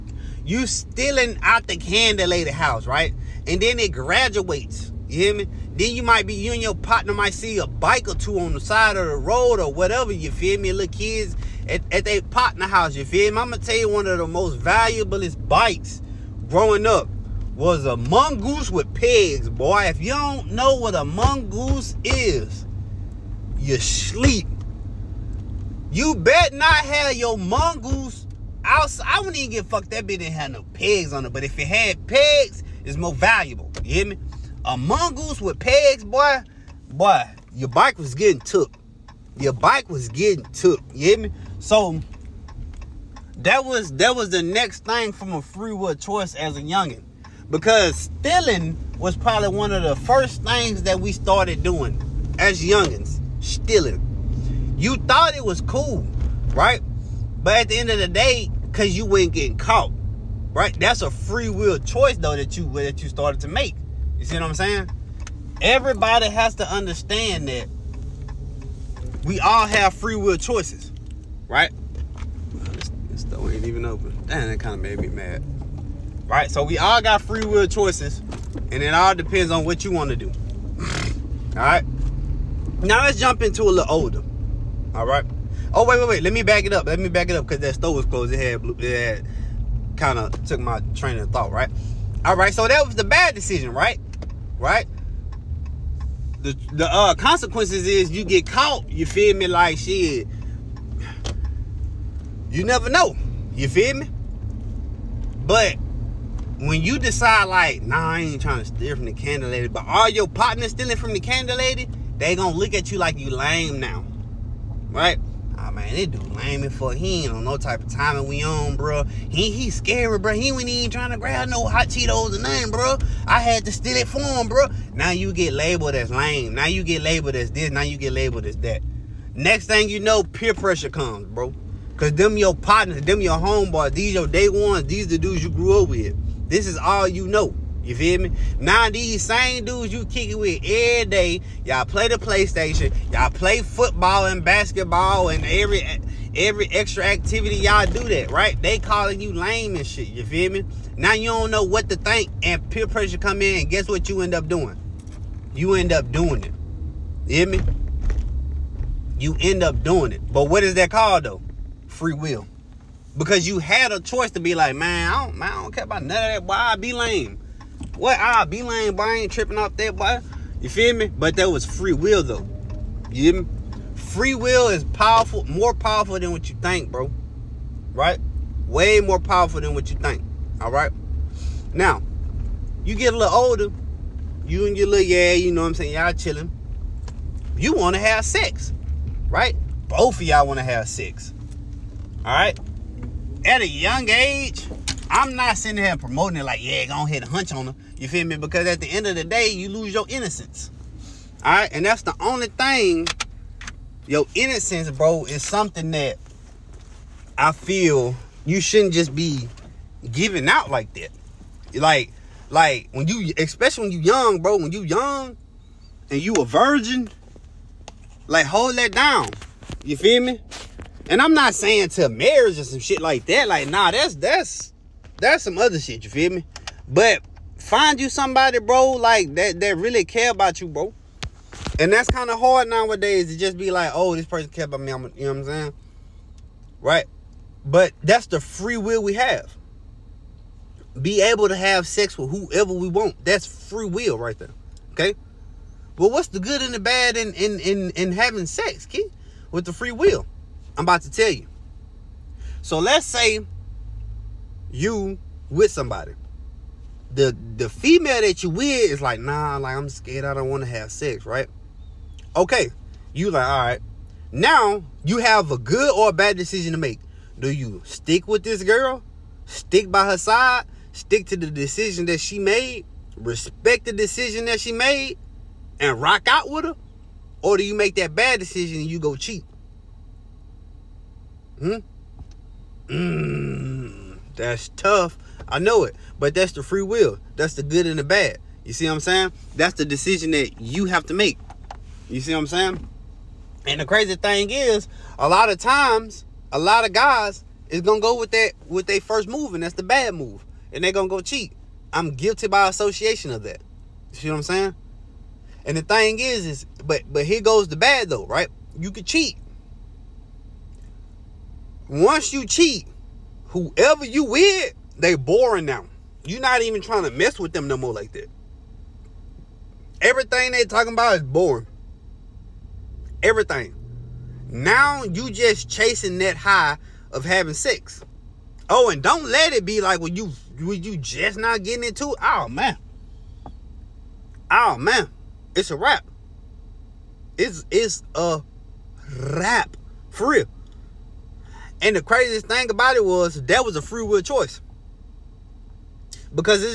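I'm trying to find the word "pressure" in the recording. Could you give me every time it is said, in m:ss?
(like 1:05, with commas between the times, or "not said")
2:10, 2:32.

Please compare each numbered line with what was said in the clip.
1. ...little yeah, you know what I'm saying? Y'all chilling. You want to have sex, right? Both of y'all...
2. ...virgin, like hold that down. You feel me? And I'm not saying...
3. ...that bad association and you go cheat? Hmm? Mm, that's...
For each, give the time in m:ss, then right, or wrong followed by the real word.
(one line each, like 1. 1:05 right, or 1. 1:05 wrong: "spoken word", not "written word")
1. 3:04 right
2. 3:36 right
3. 4:37 wrong: "decision", not "association".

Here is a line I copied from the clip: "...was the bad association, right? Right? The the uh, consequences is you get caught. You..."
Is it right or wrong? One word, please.
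wrong.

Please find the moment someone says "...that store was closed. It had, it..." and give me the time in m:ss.
1:27.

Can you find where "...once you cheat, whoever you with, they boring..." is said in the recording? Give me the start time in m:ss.
5:11.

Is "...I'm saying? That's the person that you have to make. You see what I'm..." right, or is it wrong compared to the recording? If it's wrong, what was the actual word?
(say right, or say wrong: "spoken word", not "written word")
wrong: "decision", not "person".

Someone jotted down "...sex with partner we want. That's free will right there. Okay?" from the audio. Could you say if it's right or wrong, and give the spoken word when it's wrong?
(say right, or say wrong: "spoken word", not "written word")
wrong: "whoever", not "partner".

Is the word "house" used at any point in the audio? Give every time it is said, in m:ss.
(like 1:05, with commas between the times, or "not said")
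0:02, 0:12.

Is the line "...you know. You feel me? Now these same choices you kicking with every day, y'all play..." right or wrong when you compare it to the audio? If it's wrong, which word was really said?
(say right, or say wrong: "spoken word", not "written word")
wrong: "dudes", not "choices".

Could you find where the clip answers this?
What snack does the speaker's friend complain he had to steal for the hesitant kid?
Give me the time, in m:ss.
2:01.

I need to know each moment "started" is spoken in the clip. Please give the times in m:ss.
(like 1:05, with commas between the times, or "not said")
0:51, 1:03.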